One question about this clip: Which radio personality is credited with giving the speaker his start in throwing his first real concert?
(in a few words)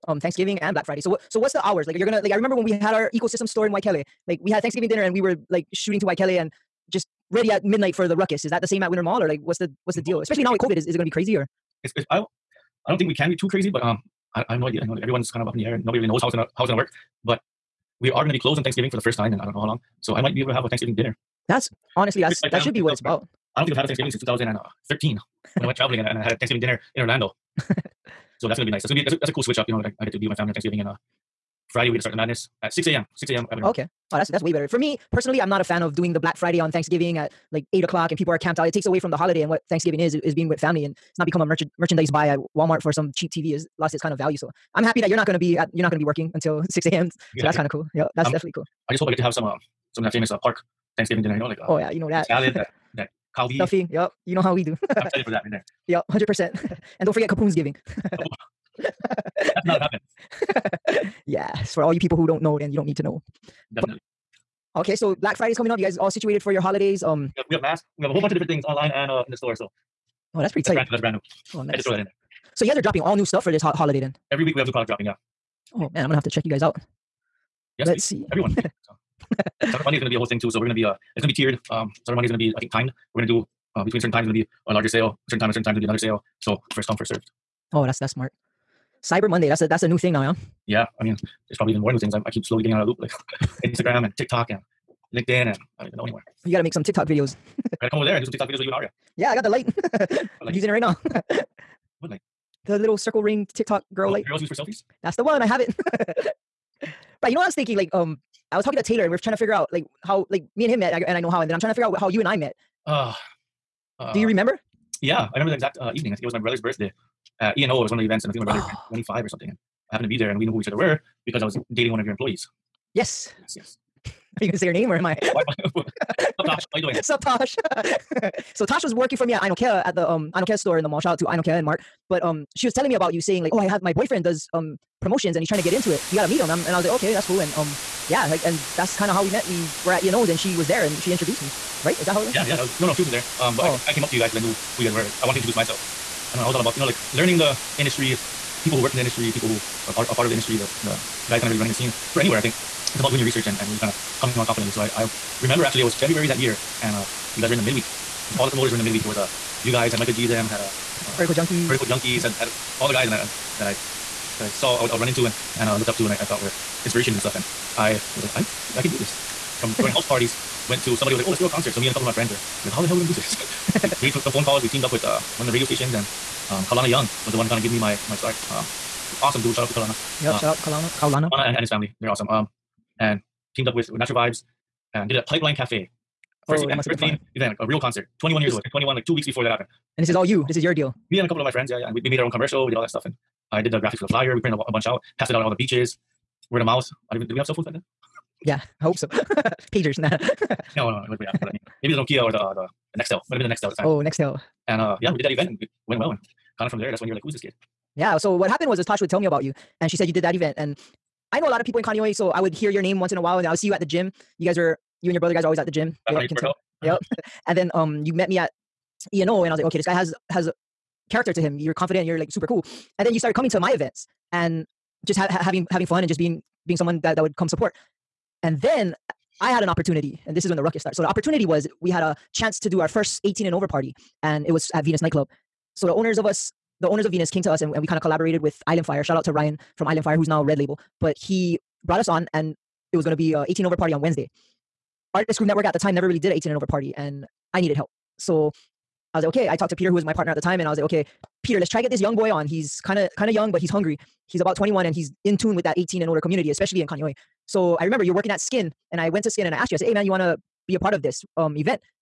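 Kalana Young.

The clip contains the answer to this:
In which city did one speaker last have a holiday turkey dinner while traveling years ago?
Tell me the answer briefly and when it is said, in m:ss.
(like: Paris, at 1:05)
Orlando, at 0:27.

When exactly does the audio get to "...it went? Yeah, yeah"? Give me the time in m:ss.
2:22.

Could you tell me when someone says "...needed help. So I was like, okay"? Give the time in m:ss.
4:07.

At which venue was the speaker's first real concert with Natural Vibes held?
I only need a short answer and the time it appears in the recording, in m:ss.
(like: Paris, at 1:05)
Pipeline Cafe, at 3:05.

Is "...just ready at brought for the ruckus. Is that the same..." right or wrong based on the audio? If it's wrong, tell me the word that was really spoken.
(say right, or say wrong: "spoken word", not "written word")
wrong: "midnight", not "brought".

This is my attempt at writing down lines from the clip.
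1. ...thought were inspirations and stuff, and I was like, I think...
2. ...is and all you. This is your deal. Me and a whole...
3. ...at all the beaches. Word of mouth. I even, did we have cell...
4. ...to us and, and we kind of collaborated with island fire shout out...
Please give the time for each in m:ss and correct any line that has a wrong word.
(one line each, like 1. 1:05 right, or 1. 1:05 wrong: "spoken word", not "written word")
1. 2:46 right
2. 3:10 wrong: "couple", not "whole"
3. 3:15 right
4. 3:57 right.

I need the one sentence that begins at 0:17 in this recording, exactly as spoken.
But we are gonna be closed on Thanksgiving for the first time, and I don't know how long.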